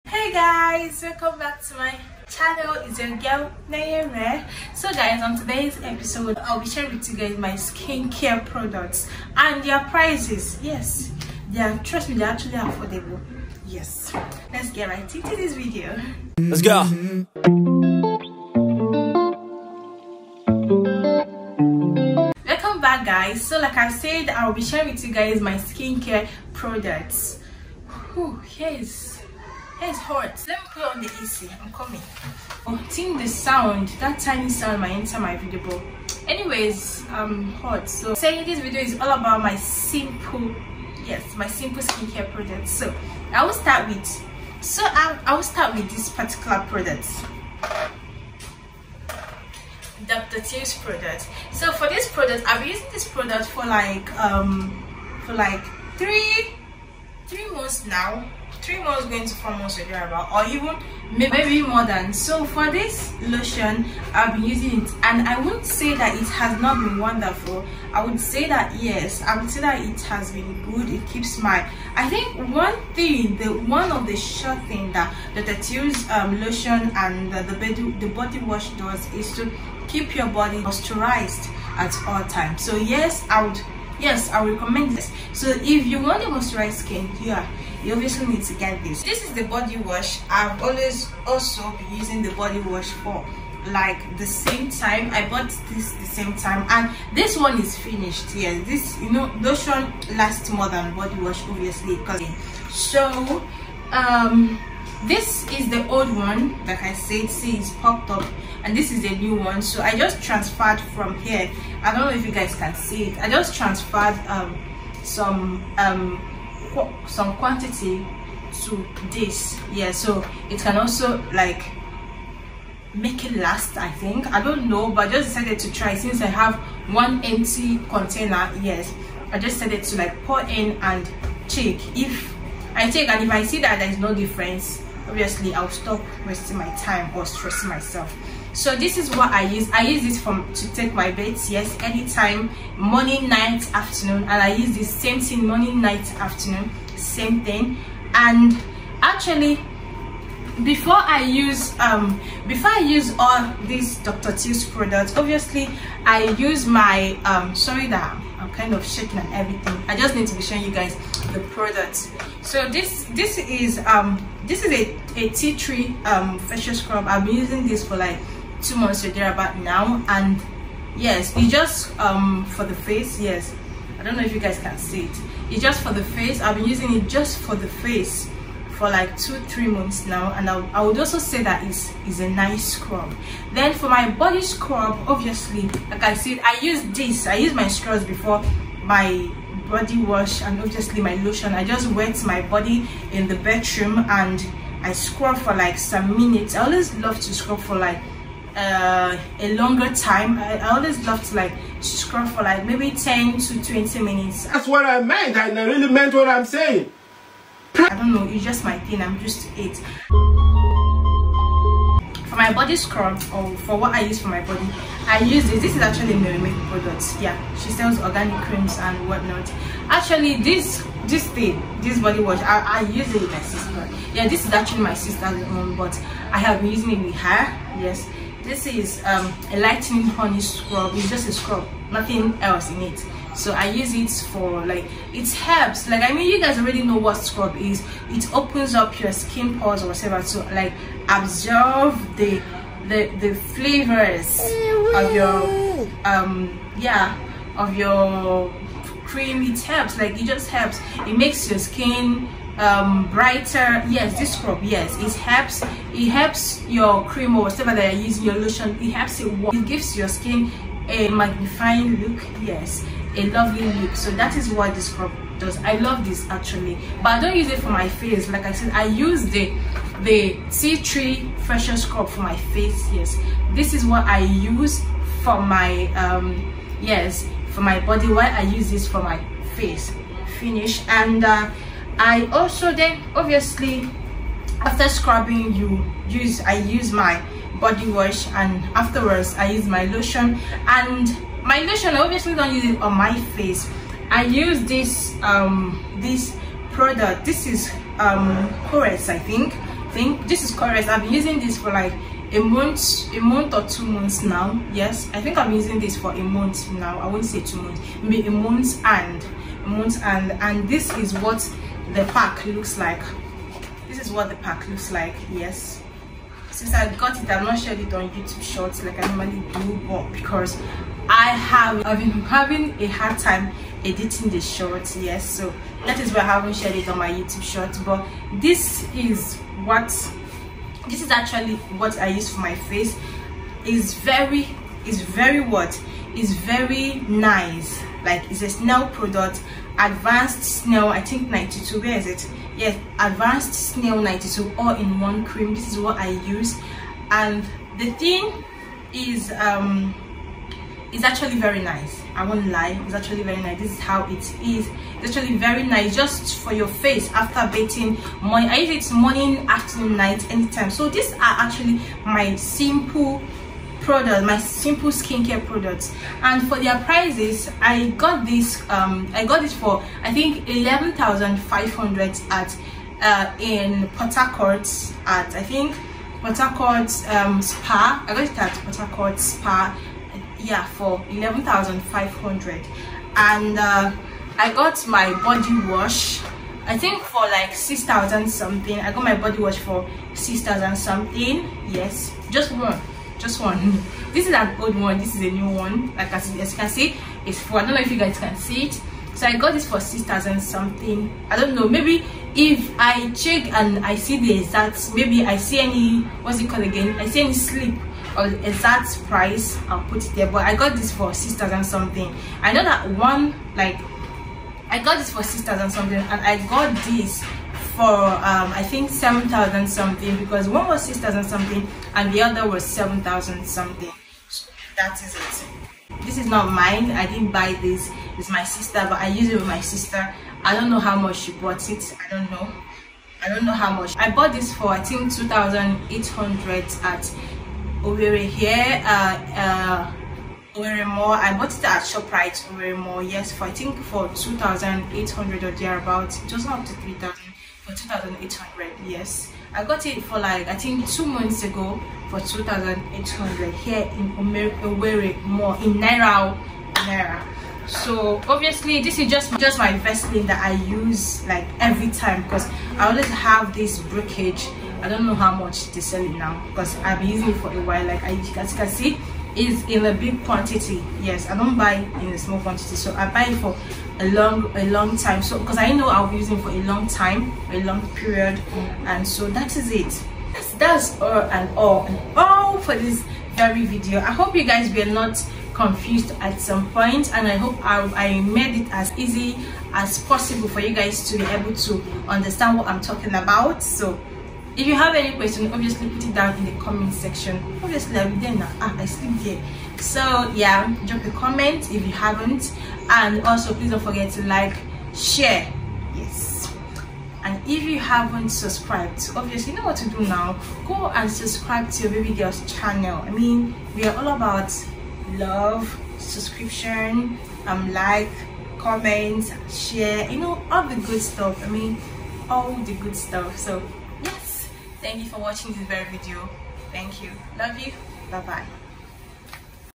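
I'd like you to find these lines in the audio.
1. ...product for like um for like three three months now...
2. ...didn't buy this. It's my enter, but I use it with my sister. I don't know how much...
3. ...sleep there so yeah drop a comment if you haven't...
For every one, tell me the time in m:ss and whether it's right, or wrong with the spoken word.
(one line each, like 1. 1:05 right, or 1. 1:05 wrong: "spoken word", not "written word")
1. 0:53 right
2. 7:07 wrong: "sister", not "enter"
3. 8:18 right.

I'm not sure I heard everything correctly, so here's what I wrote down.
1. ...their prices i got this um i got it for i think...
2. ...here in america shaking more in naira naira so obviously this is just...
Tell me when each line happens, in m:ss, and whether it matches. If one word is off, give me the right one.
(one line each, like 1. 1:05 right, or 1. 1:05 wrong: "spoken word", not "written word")
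1. 6:06 right
2. 7:33 wrong: "wearing", not "shaking".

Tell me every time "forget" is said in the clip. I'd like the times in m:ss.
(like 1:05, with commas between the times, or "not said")
8:23.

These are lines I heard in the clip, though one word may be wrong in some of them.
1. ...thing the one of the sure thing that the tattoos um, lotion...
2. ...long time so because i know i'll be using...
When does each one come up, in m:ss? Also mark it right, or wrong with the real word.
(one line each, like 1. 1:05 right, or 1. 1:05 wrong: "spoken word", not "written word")
1. 1:12 right
2. 7:54 right.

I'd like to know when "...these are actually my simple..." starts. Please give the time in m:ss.
6:00.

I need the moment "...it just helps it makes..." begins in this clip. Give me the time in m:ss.
4:10.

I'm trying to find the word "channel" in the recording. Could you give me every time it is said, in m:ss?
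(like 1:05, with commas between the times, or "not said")
0:02, 8:32.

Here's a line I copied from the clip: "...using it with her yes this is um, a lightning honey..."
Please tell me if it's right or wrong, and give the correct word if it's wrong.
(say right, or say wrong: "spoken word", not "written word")
right.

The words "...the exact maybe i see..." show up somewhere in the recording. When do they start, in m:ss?
6:44.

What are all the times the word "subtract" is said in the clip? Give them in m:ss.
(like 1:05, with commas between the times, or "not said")
not said.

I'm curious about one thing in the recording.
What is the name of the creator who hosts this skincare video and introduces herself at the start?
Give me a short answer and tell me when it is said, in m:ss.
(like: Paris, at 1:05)
Nayeme, at 0:03.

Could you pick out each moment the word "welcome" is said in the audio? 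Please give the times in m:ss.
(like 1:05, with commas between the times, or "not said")
0:01, 0:22.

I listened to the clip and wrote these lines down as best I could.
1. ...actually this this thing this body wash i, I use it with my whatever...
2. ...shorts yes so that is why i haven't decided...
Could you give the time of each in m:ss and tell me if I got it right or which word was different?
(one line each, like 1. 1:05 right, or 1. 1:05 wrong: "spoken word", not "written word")
1. 3:39 wrong: "sister", not "whatever"
2. 5:24 wrong: "shared", not "decided".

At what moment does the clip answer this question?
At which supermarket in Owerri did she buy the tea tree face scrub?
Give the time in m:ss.
7:21.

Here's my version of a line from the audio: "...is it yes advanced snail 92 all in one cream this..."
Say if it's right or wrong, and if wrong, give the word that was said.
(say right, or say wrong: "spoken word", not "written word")
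right.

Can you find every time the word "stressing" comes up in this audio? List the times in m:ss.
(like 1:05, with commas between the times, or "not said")
2:17.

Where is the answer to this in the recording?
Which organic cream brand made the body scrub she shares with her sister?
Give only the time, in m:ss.
3:36.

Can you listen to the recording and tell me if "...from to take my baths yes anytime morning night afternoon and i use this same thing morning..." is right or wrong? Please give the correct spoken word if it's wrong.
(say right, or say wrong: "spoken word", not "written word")
right.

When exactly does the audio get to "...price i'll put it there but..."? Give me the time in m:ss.
6:49.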